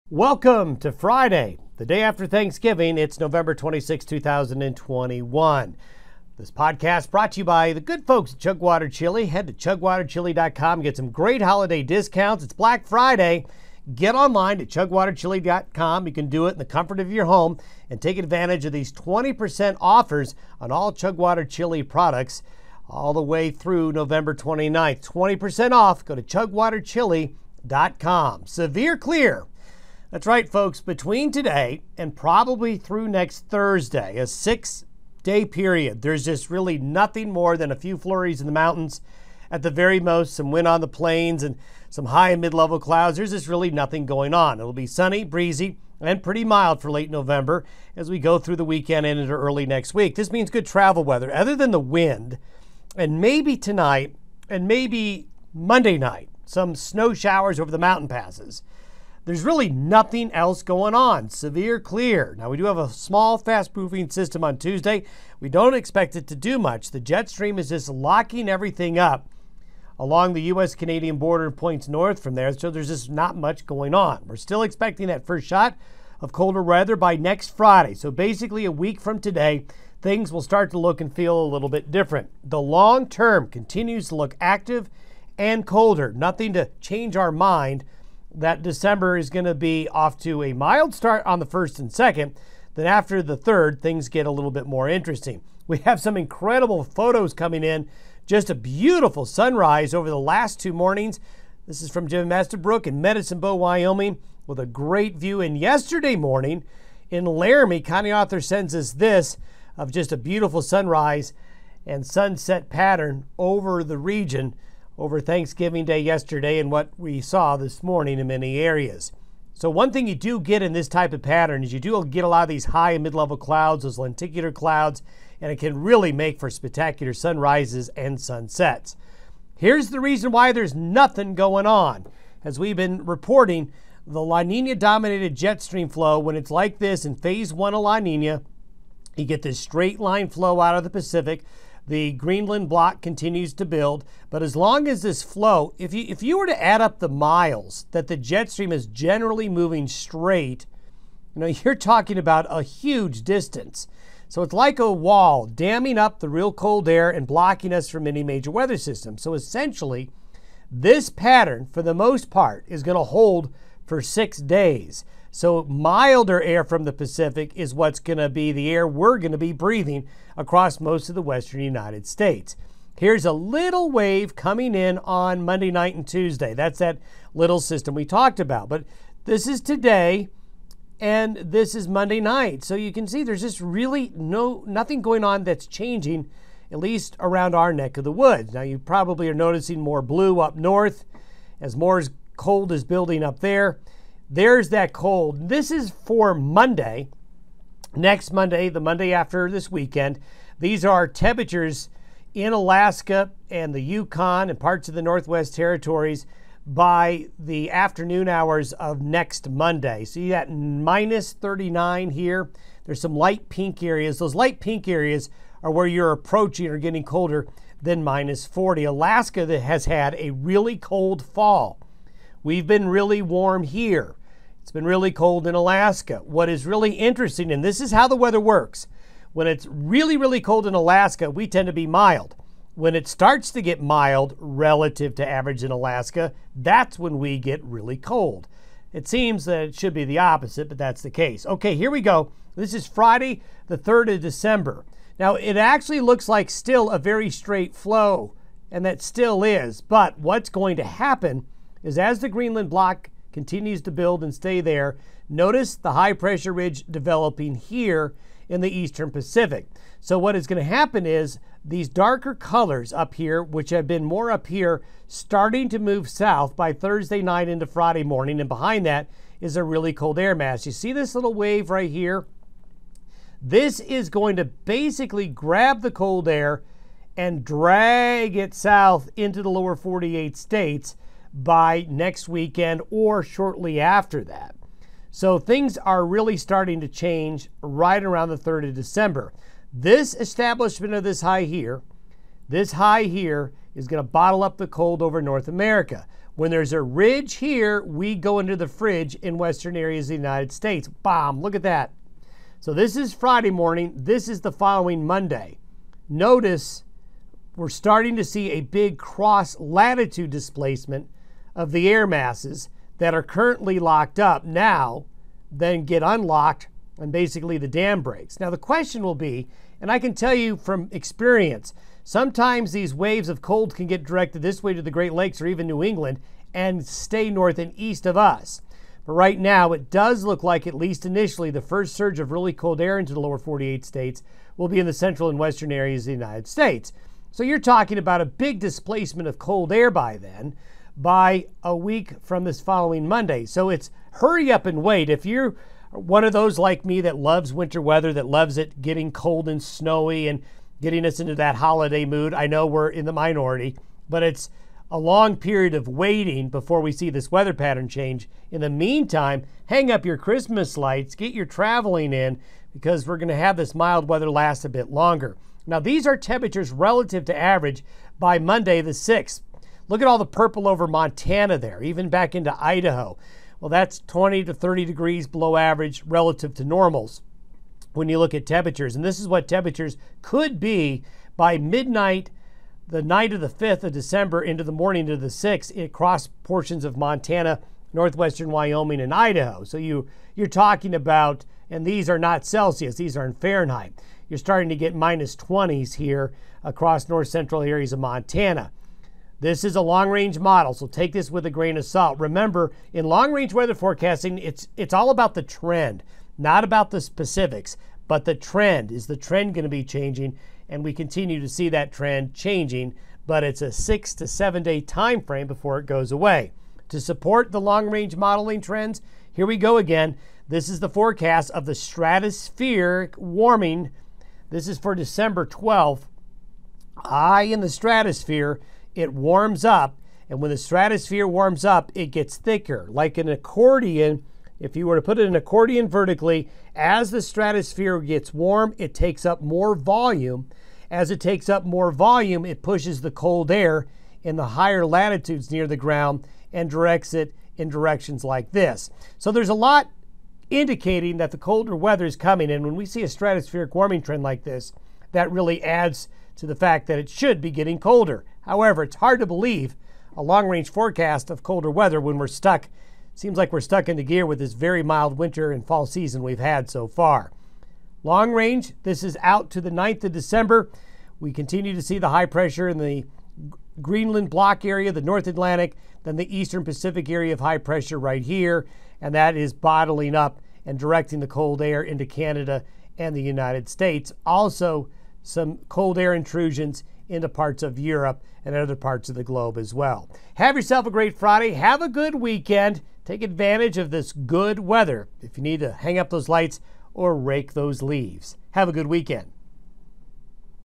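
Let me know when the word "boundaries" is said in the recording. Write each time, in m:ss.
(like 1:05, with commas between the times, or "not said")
not said.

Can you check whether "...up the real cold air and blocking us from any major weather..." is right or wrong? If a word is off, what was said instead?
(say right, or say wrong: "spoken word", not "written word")
right.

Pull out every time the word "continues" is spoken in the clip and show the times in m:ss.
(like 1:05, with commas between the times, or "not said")
1:23, 2:23, 4:13, 6:50, 7:51.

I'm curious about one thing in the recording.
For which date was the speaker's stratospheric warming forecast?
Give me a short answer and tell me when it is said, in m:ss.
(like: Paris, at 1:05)
December 12th, at 7:04.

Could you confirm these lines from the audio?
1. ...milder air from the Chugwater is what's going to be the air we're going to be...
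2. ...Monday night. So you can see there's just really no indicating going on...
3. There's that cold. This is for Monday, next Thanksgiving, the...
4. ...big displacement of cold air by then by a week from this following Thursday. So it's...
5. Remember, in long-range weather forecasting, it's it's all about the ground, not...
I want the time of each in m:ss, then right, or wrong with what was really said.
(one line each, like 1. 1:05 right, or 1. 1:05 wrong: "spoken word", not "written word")
1. 2:45 wrong: "Pacific", not "Chugwater"
2. 3:01 wrong: "nothing", not "indicating"
3. 3:14 wrong: "Monday", not "Thanksgiving"
4. 5:38 wrong: "Monday", not "Thursday"
5. 6:42 wrong: "trend", not "ground".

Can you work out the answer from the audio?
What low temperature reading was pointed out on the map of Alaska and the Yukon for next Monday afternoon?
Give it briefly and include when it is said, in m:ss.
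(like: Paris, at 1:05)
-39, at 3:30.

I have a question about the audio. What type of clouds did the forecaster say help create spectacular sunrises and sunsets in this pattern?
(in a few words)
Lenticular clouds.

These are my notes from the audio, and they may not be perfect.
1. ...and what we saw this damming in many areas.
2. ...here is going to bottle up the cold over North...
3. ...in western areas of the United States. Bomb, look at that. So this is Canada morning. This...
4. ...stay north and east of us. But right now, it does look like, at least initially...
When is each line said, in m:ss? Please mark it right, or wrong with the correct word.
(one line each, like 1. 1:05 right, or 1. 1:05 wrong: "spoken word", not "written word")
1. 1:56 wrong: "morning", not "damming"
2. 4:53 right
3. 4:59 wrong: "Friday", not "Canada"
4. 5:26 right.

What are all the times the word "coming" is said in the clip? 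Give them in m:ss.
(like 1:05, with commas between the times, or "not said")
1:37, 2:54, 7:32.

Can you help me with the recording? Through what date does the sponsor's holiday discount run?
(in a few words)
November 29th.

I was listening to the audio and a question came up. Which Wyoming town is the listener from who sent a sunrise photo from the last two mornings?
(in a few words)
Medicine Bow.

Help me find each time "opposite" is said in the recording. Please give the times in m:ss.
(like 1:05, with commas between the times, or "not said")
4:00.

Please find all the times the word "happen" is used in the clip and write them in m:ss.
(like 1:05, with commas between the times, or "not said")
4:10, 4:20.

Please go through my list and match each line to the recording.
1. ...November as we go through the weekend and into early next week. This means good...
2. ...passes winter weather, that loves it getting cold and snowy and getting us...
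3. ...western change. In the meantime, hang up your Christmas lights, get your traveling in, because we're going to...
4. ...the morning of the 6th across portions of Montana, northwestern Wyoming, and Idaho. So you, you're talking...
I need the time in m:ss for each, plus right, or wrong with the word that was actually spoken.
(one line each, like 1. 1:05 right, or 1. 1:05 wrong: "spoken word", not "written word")
1. 0:47 right
2. 5:47 wrong: "loves", not "passes"
3. 5:57 wrong: "pattern", not "western"
4. 6:24 right.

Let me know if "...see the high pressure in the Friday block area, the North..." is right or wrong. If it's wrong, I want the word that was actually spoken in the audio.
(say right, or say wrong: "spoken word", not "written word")
wrong: "Greenland", not "Friday".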